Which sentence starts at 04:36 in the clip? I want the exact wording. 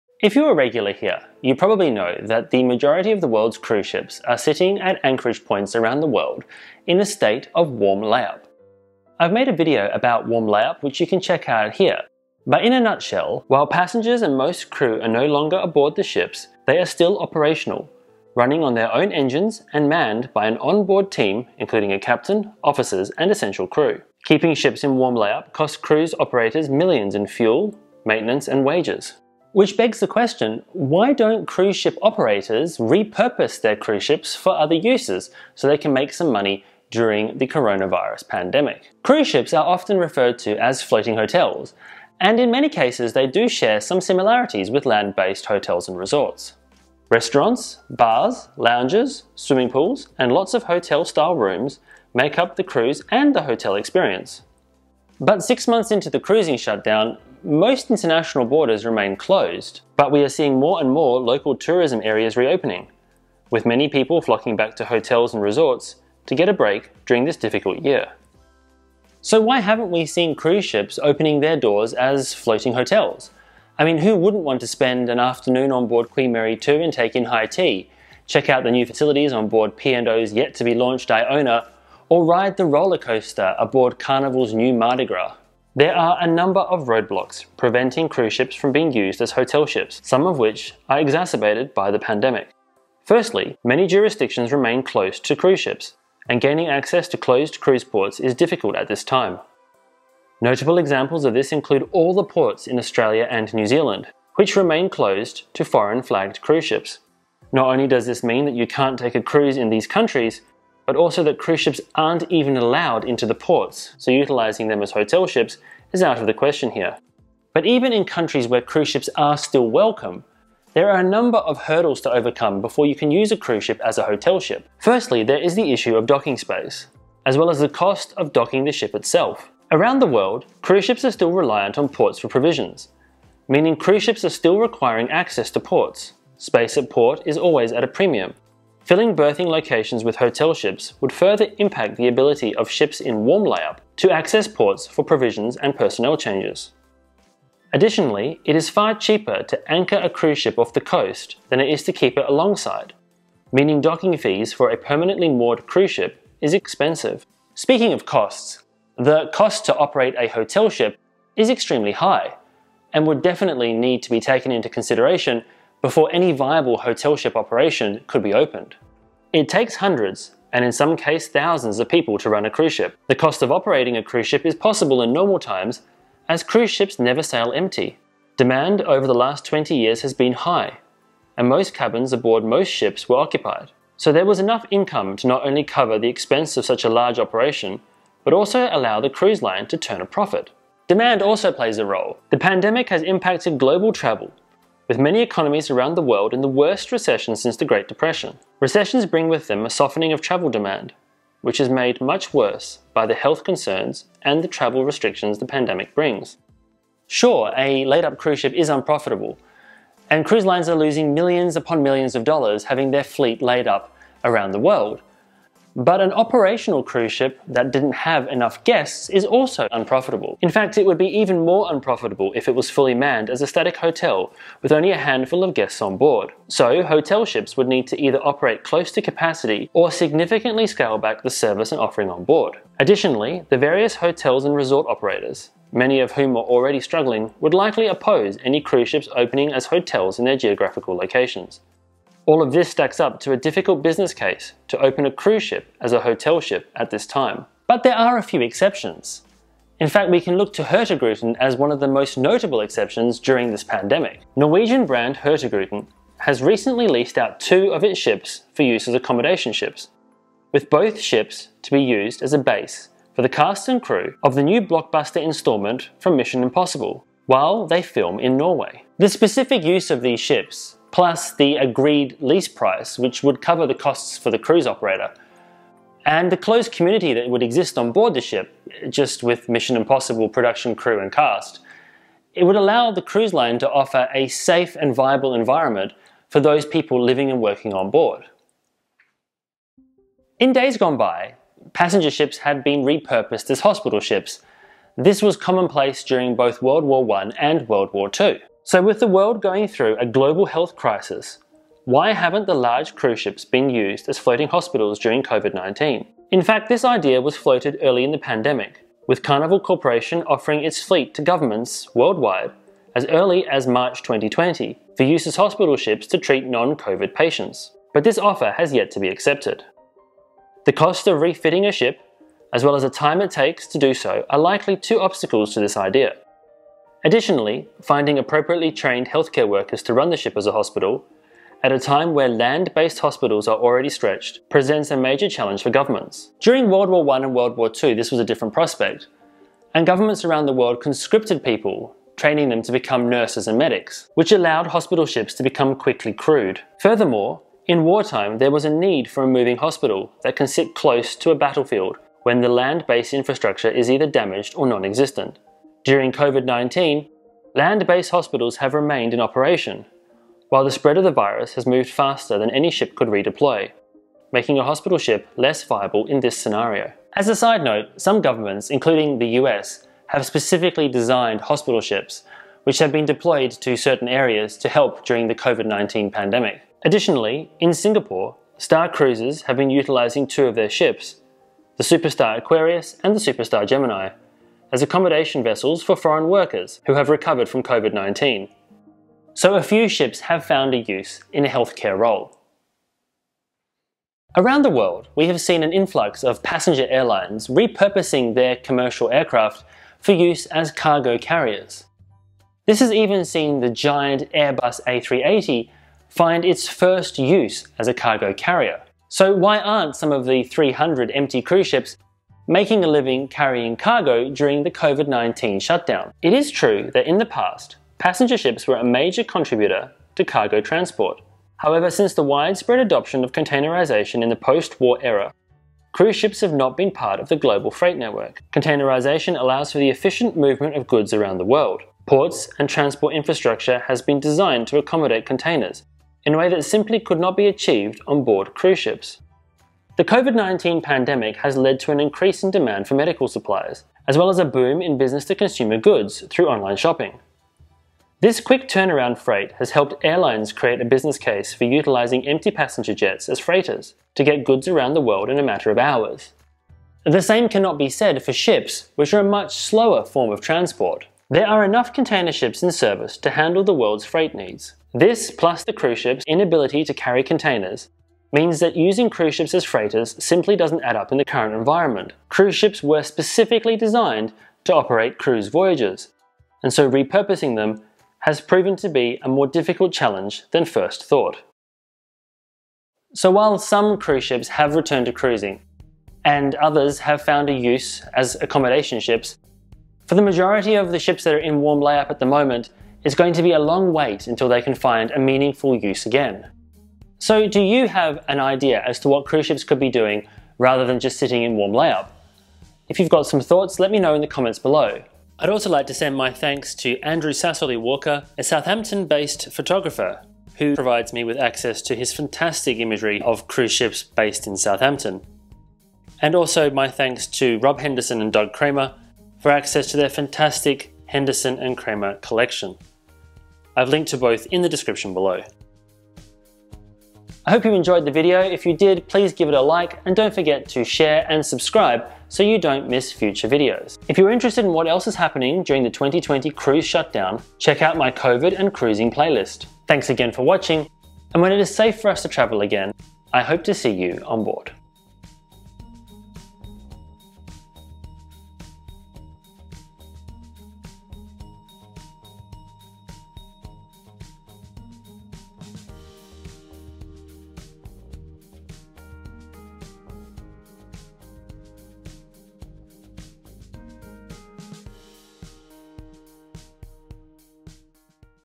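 And the closed community that would exist on board the ship, just with Mission Impossible production crew and cast.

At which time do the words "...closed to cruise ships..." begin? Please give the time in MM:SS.
01:34.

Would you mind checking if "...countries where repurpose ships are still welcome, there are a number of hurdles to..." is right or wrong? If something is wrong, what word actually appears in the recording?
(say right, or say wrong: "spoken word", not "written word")
wrong: "cruise", not "repurpose".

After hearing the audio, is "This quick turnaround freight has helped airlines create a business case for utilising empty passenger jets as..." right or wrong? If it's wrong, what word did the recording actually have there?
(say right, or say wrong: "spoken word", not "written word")
right.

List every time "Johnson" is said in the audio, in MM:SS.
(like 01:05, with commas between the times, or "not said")
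not said.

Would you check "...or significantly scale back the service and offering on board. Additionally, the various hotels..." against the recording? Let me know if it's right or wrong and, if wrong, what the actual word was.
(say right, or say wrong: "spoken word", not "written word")
right.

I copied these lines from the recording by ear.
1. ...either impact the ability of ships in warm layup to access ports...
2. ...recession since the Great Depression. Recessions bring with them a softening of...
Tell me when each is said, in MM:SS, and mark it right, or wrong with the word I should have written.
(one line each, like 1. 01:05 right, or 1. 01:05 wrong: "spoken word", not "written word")
1. 02:21 wrong: "further", not "either"
2. 03:16 right.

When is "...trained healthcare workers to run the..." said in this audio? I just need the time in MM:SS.
05:28.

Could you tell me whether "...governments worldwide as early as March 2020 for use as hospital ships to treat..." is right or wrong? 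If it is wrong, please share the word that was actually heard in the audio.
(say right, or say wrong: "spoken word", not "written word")
right.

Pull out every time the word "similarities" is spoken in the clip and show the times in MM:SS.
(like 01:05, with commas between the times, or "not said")
00:43.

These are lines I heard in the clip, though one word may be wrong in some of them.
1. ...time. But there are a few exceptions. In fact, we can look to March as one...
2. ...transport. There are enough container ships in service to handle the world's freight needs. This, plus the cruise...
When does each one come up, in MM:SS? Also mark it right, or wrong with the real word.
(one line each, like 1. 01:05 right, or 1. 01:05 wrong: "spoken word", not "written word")
1. 04:07 wrong: "Hurtigruten", not "March"
2. 07:40 right.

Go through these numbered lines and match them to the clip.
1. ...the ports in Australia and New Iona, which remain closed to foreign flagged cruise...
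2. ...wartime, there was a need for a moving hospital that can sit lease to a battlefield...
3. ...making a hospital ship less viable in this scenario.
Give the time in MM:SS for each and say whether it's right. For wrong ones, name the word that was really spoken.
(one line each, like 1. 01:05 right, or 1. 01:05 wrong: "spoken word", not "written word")
1. 01:42 wrong: "Zealand", not "Iona"
2. 05:47 wrong: "close", not "lease"
3. 06:04 right.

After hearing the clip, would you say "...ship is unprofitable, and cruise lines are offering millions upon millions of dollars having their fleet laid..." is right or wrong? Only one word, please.
wrong.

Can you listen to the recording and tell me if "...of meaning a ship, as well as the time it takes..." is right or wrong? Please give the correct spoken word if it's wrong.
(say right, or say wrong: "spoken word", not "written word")
wrong: "refitting", not "meaning".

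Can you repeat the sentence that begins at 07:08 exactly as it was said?
Containerization allows for the efficient movement of goods around the world.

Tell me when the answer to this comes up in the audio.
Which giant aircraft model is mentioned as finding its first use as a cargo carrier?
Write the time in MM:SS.
06:44.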